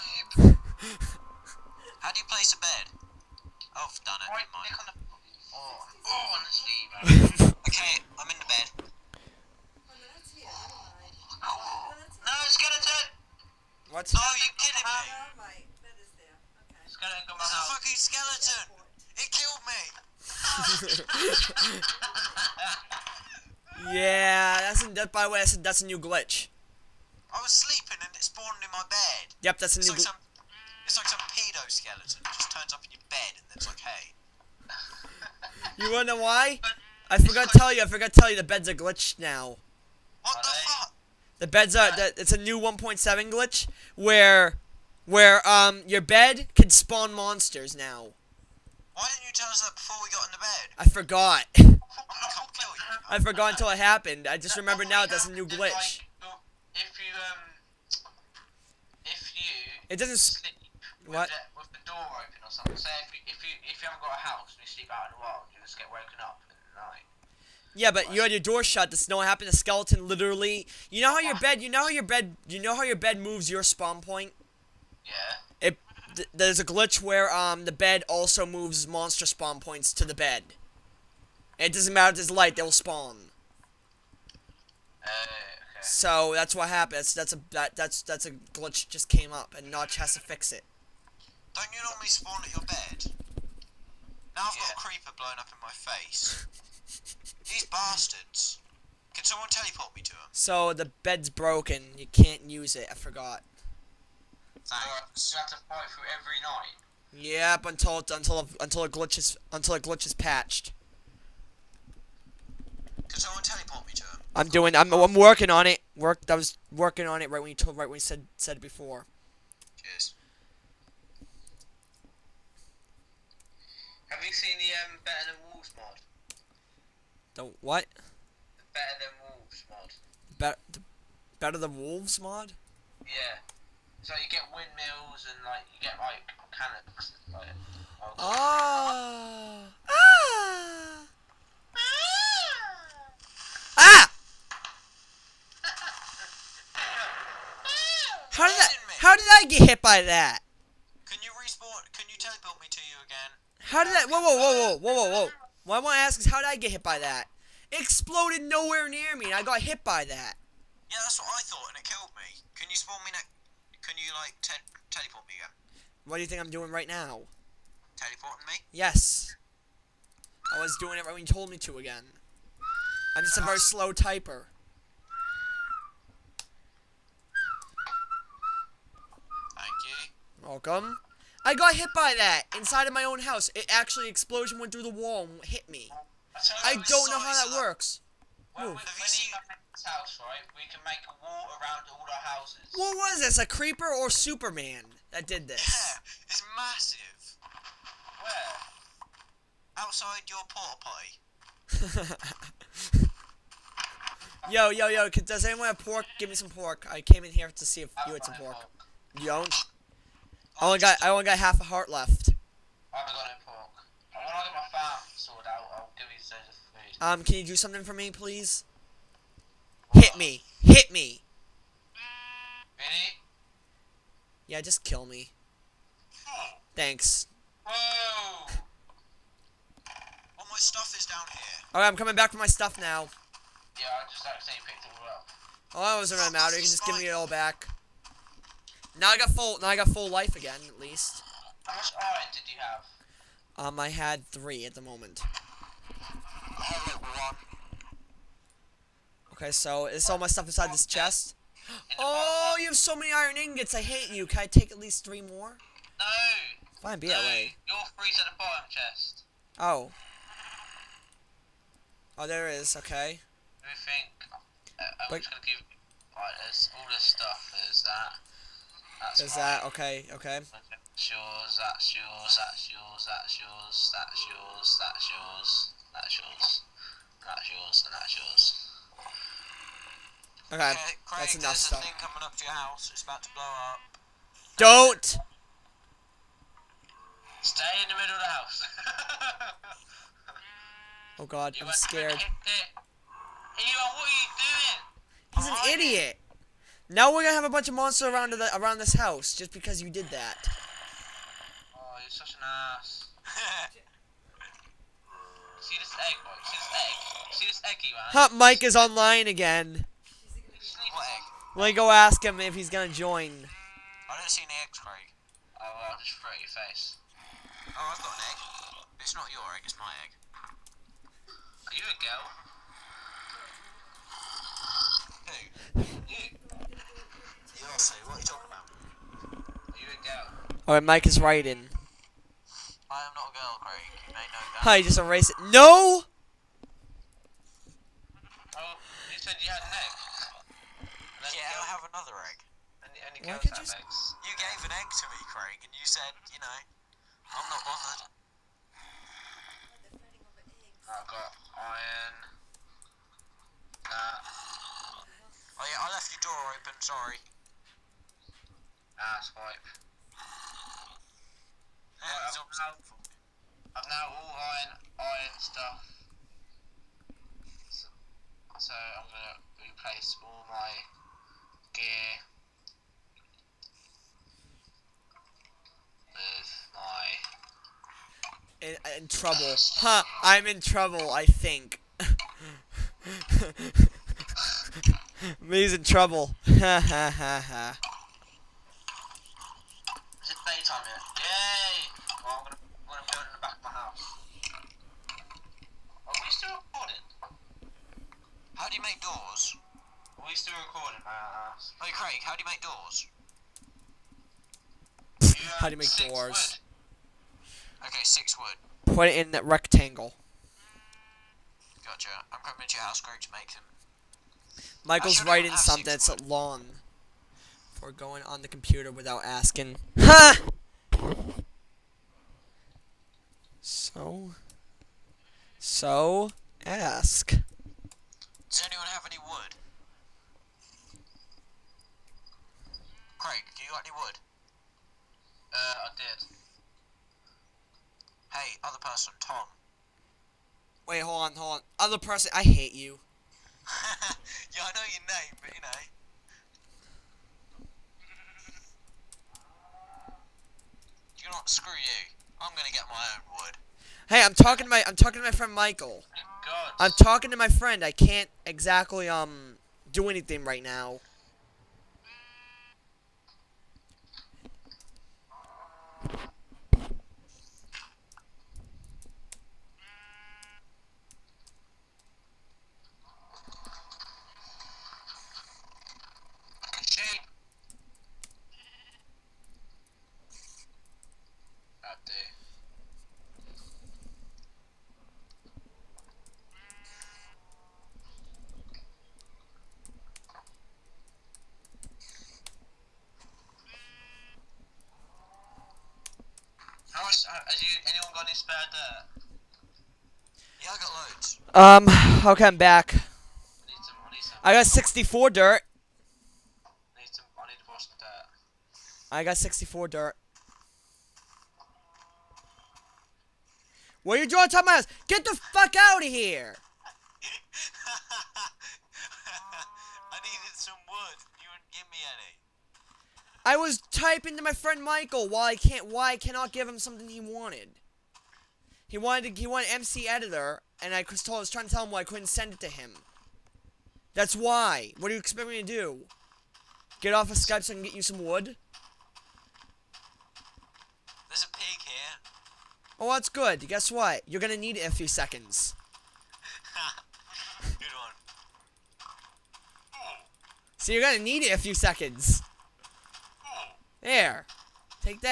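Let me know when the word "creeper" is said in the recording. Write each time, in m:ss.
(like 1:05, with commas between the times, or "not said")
1:34, 3:13.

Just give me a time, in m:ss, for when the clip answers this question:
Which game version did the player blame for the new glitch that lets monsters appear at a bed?
0:42.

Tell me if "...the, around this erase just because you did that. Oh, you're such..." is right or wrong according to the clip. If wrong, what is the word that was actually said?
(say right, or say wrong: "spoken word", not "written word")
wrong: "house", not "erase".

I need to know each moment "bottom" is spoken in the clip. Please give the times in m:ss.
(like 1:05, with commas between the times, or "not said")
4:18.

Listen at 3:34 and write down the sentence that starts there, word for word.
get my farm sorted out, I'll give you some food.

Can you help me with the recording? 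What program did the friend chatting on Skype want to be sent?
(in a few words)
MC editor.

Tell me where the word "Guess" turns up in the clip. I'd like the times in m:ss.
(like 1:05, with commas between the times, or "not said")
9:03.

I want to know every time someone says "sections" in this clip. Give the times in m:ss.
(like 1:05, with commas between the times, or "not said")
not said.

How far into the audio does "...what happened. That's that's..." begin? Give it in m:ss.
1:26.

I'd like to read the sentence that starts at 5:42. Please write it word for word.
And the only girls have eggs.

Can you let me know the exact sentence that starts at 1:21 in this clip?
it doesn't matter if there's light; they'll spawn.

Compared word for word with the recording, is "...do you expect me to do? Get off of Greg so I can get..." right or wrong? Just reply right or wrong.
wrong.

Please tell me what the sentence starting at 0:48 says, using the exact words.
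Why didn't you tell us that before we got in the bed?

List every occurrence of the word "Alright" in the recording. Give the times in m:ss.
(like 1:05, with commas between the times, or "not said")
3:51, 5:30.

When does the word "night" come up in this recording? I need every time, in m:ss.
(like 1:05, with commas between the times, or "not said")
1:06, 1:46.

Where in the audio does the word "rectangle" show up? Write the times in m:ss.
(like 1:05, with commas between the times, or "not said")
6:49.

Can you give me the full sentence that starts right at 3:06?
I don't know how that works.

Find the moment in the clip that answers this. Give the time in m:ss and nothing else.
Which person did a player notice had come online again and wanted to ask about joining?
5:08.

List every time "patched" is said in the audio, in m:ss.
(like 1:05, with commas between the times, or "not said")
1:50.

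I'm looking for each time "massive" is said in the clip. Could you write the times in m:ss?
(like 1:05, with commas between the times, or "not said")
3:16.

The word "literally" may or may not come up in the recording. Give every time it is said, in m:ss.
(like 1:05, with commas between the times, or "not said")
1:10.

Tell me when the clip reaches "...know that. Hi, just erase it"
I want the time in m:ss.
5:34.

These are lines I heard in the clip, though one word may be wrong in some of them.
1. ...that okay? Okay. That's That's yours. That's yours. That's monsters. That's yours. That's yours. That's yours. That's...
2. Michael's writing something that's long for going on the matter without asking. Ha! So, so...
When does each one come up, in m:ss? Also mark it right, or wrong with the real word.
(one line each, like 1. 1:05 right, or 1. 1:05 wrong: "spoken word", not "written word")
1. 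4:29 wrong: "yours", not "monsters"
2. 6:54 wrong: "computer", not "matter".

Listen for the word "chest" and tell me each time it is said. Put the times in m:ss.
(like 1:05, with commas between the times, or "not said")
4:10, 4:18.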